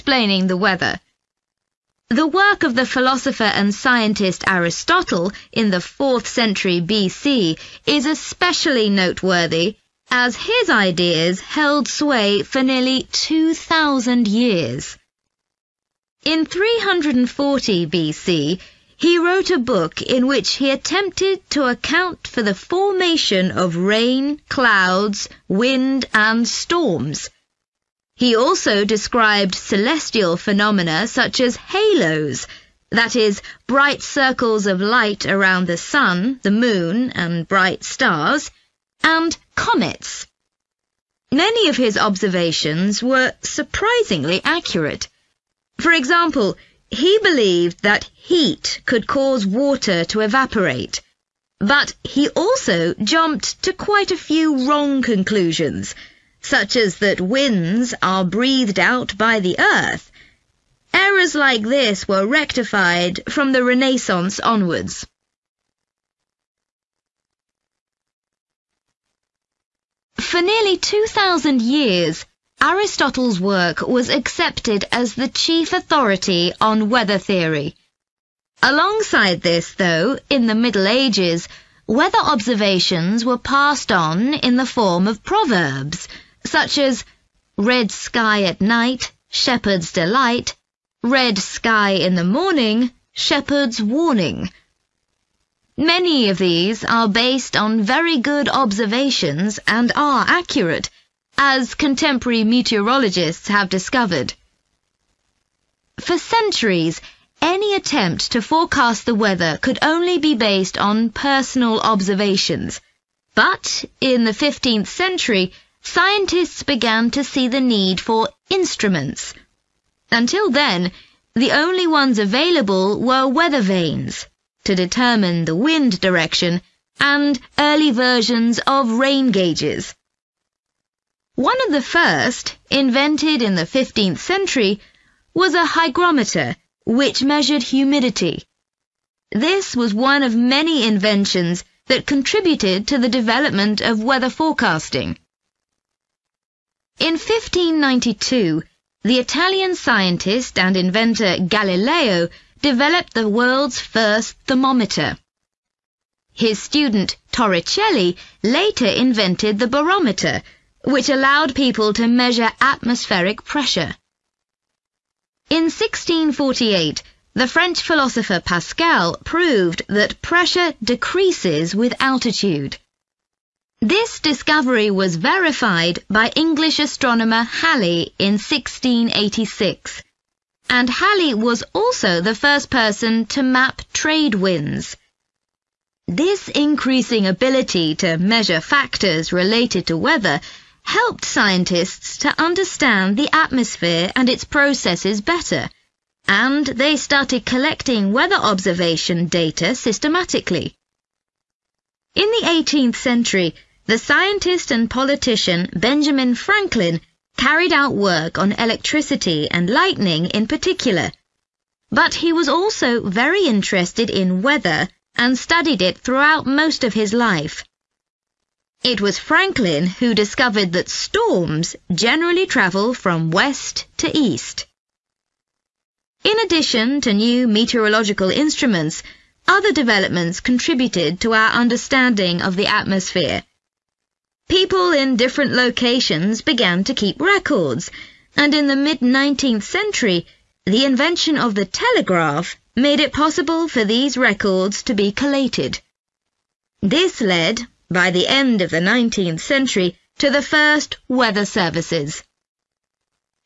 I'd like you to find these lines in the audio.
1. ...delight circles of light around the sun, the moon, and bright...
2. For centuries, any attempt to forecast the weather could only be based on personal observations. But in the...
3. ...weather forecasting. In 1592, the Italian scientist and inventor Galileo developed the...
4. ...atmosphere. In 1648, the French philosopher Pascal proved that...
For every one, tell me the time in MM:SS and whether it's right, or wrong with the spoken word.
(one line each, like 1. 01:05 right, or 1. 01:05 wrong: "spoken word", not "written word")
1. 00:33 wrong: "bright", not "delight"
2. 01:45 right
3. 02:24 right
4. 02:43 wrong: "pressure", not "atmosphere".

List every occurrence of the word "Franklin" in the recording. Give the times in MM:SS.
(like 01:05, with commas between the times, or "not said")
03:26, 03:39.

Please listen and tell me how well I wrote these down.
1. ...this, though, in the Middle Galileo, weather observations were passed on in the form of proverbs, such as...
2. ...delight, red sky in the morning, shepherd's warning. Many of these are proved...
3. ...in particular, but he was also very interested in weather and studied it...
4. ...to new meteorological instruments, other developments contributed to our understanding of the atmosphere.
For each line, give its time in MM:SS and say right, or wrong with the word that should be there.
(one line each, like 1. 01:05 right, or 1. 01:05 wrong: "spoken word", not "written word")
1. 01:19 wrong: "Ages", not "Galileo"
2. 01:29 wrong: "based", not "proved"
3. 03:30 right
4. 03:46 right.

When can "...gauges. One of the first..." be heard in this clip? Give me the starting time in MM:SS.
02:09.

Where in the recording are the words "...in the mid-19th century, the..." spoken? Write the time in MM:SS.
03:58.